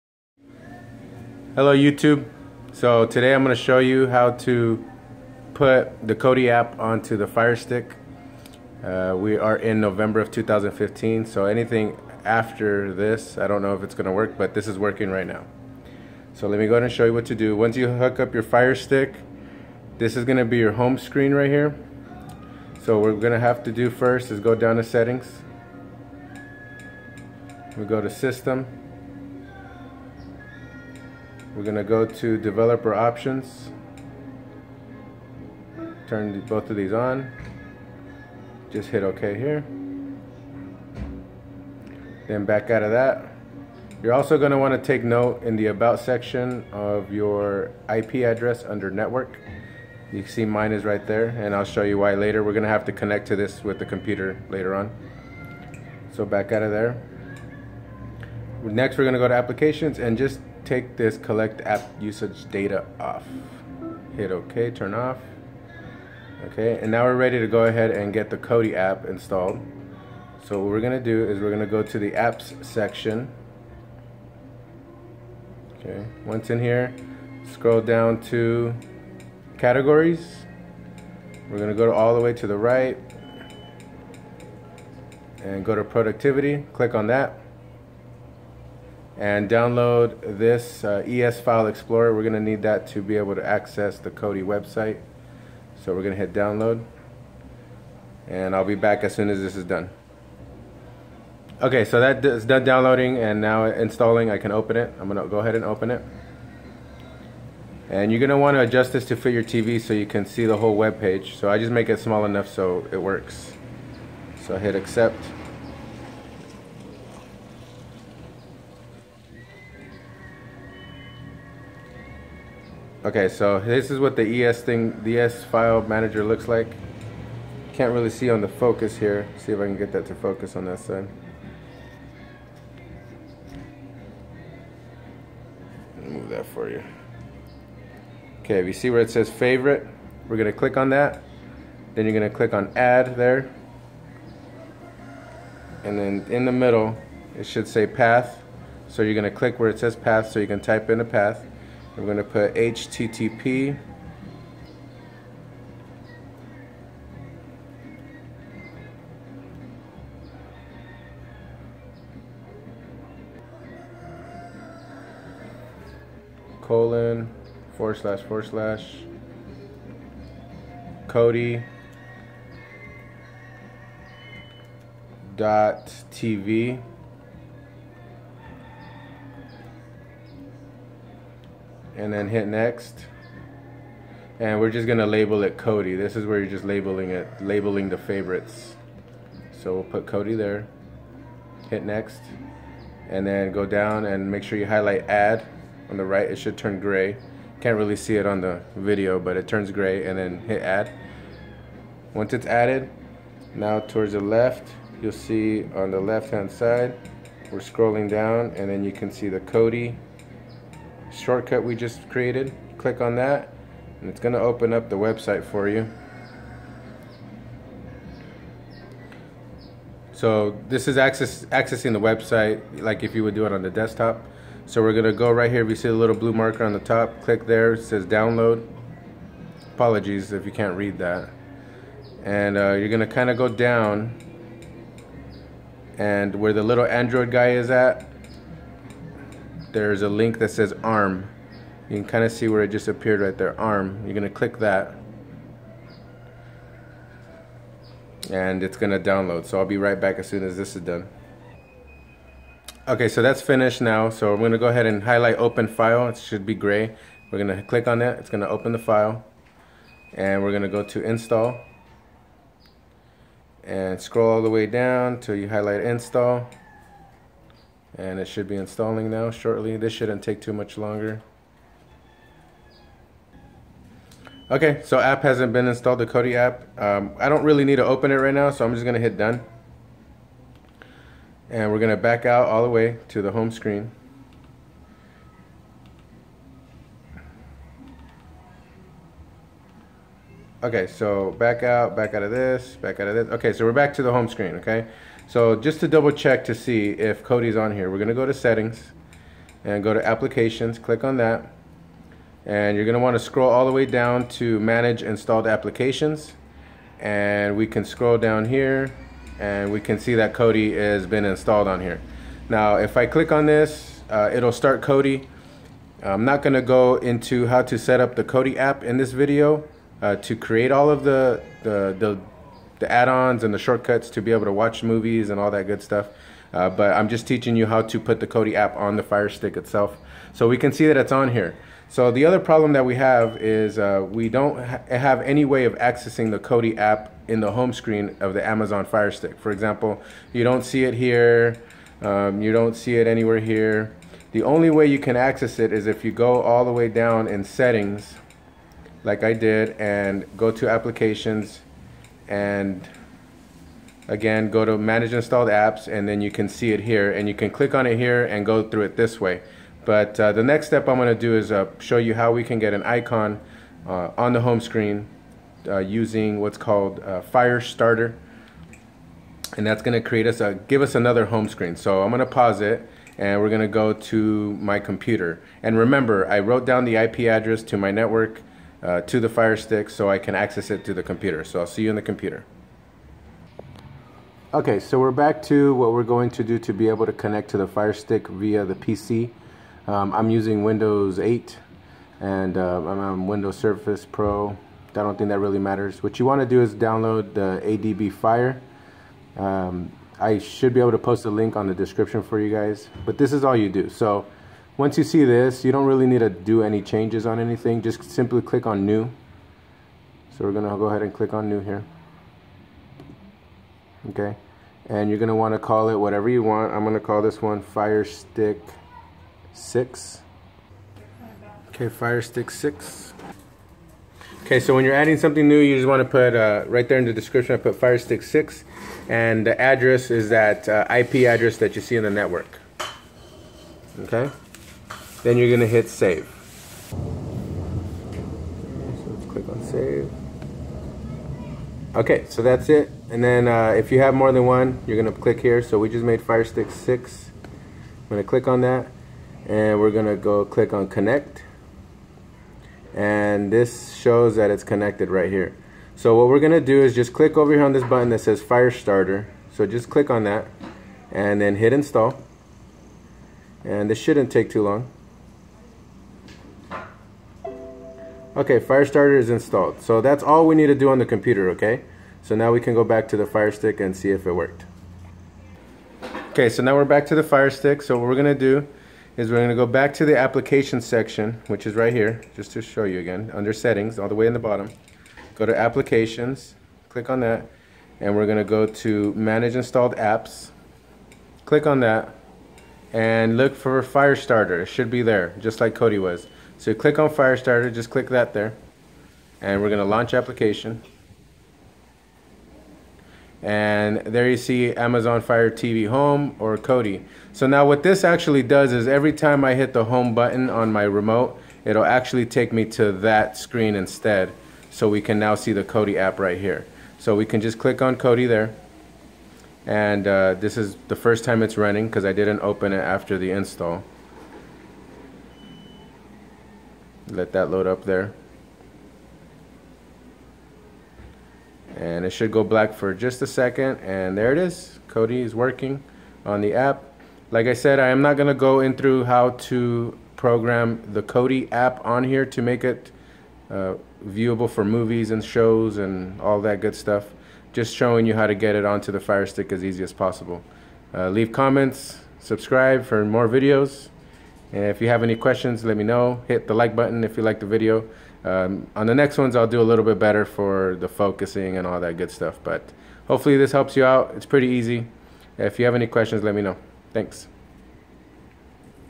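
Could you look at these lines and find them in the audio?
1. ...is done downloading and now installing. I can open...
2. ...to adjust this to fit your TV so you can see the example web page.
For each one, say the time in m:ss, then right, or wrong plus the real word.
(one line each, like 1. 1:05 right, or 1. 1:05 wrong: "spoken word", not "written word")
1. 1:42 right
2. 1:48 wrong: "whole", not "example".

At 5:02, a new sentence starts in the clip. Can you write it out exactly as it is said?
And you're gonna wanna scroll all the way down to manage installed applications.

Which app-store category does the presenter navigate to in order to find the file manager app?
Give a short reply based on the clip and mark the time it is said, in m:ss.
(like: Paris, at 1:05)
Productivity, at 1:25.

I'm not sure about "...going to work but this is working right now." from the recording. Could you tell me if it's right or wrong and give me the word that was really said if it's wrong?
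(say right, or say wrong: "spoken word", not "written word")
right.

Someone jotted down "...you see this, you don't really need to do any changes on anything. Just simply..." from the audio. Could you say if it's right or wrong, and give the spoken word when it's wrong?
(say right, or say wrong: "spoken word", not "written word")
right.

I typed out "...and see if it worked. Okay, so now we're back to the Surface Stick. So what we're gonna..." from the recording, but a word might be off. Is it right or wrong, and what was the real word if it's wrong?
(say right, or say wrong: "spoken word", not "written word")
wrong: "Fire", not "Surface".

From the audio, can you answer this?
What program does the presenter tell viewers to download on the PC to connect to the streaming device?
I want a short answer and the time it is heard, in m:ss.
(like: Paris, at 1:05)
ADB Fire, at 6:37.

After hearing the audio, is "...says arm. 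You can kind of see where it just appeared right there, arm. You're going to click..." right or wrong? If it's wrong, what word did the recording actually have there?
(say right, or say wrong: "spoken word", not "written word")
right.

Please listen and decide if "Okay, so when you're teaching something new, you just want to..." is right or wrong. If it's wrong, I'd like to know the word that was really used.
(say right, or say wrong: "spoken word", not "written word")
wrong: "adding", not "teaching".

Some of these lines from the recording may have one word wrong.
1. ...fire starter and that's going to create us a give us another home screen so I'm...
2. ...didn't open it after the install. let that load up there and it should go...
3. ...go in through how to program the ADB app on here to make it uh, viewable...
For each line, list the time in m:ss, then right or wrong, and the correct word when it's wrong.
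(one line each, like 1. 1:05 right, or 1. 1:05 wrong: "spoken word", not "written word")
1. 6:07 right
2. 8:42 right
3. 8:58 wrong: "Kodi", not "ADB".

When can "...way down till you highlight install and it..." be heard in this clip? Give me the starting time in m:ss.
4:24.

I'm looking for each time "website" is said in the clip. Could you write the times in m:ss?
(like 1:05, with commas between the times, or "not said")
1:34, 3:34, 3:41.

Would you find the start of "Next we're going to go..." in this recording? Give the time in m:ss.
0:58.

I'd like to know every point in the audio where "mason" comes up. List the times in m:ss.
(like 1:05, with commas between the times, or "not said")
not said.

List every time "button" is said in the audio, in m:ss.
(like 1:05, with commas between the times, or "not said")
7:37, 8:30, 9:16.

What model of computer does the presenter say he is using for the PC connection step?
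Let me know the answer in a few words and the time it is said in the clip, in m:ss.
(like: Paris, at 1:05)
Surface Pro, at 6:33.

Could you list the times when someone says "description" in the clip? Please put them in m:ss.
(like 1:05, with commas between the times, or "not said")
6:41, 7:07.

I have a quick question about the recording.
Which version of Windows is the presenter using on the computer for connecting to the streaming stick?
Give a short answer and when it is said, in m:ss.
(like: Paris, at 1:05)
Windows 8, at 6:30.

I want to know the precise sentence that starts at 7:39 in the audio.
So just click on that and then hit install.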